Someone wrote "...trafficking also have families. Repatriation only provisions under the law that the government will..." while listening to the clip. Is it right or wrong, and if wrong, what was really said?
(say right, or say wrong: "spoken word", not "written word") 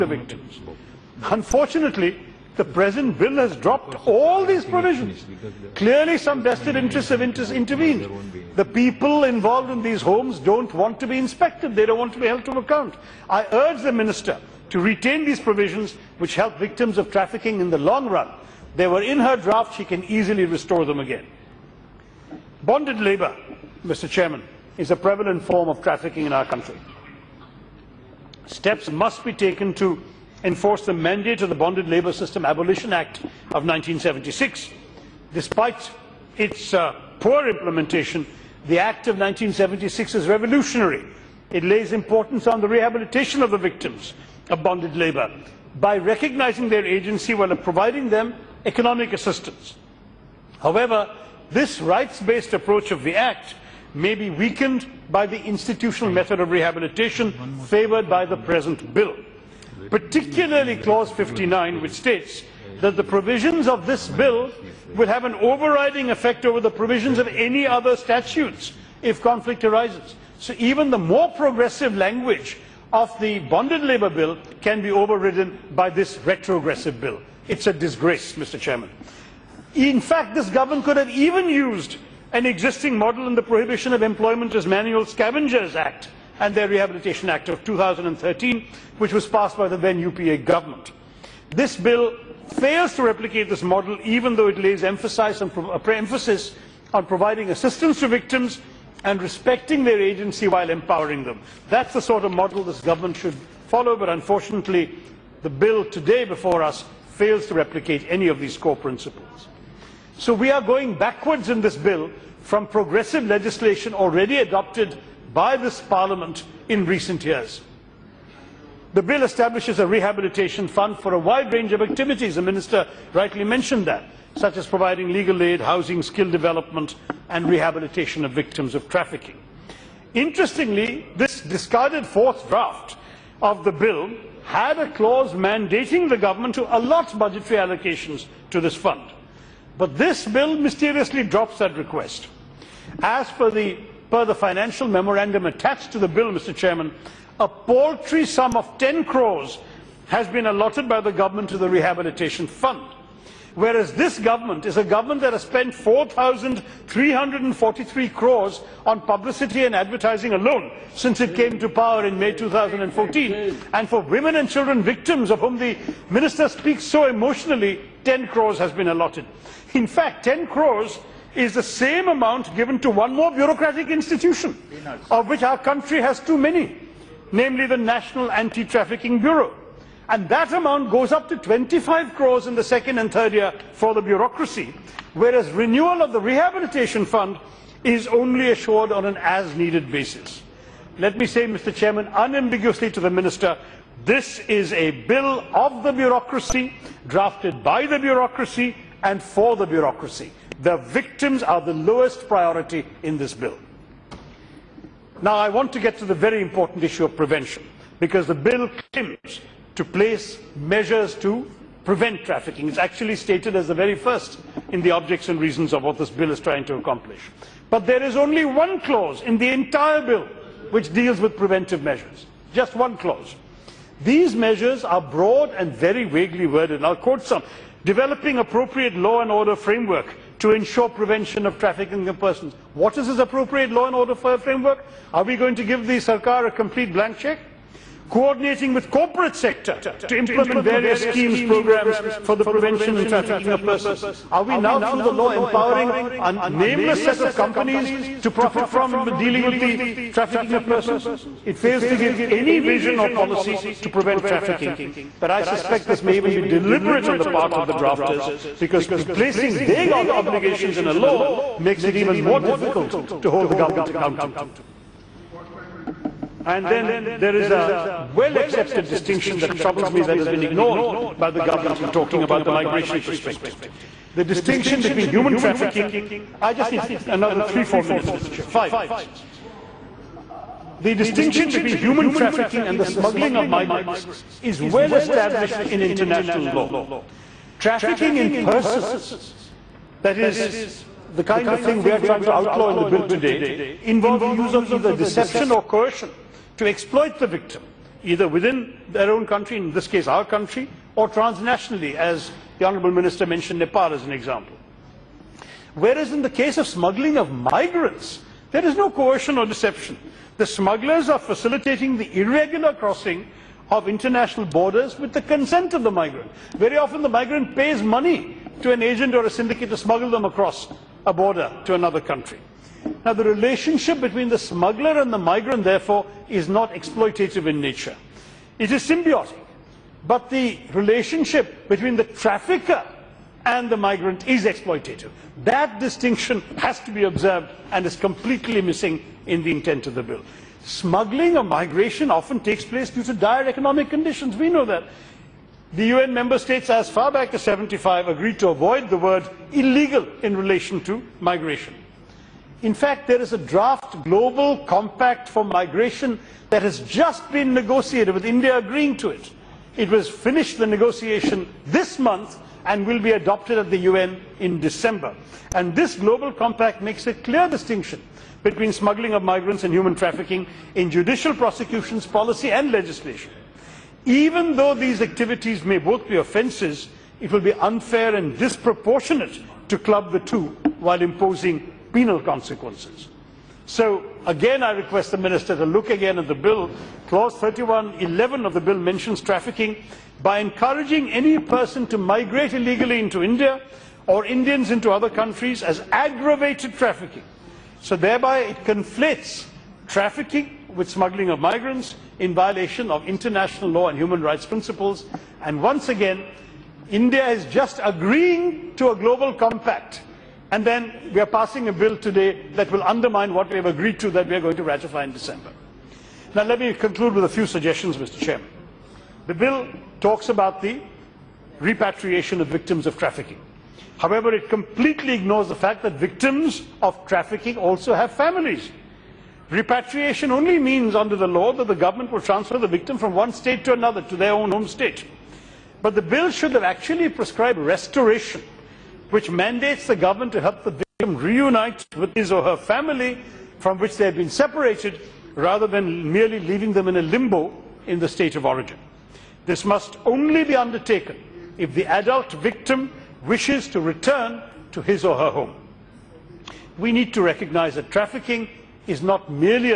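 wrong: "means", not "provisions".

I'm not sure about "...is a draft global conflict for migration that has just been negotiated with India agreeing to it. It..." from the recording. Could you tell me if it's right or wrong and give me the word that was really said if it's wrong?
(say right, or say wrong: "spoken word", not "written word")
wrong: "compact", not "conflict".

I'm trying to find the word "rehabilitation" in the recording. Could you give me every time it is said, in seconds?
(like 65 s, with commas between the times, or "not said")
42 s, 56 s, 86 s, 119 s, 127 s, 151 s, 186 s.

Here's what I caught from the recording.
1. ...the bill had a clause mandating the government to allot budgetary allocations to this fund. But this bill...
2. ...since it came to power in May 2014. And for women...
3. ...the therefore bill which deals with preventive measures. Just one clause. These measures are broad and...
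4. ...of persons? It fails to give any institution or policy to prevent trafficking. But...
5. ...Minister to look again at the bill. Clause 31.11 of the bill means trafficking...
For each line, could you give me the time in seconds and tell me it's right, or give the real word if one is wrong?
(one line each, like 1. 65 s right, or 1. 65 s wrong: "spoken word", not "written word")
1. 133 s right
2. 160 s right
3. 219 s wrong: "entire", not "therefore"
4. 250 s wrong: "vision", not "institution"
5. 385 s wrong: "mentions", not "means".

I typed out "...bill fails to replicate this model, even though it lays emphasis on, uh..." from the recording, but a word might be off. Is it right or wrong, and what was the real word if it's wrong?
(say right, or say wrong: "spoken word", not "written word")
right.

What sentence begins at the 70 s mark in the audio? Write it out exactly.
So even the more progressive language of the bonded labour bill can be overridden by this retrogressive bill.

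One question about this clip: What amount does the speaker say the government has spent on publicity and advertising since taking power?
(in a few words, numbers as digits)
4,343 crores.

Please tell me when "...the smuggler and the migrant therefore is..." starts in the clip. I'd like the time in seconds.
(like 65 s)
324 s.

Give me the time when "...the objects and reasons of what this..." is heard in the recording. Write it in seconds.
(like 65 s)
214 s.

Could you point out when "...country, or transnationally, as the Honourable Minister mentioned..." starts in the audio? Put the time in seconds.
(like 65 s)
300 s.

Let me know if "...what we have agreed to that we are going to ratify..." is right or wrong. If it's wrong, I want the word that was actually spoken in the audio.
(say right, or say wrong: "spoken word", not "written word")
right.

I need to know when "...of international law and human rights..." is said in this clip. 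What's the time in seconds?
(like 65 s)
402 s.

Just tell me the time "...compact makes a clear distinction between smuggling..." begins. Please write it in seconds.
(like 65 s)
366 s.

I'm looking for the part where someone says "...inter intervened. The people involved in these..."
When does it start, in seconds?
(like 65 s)
7 s.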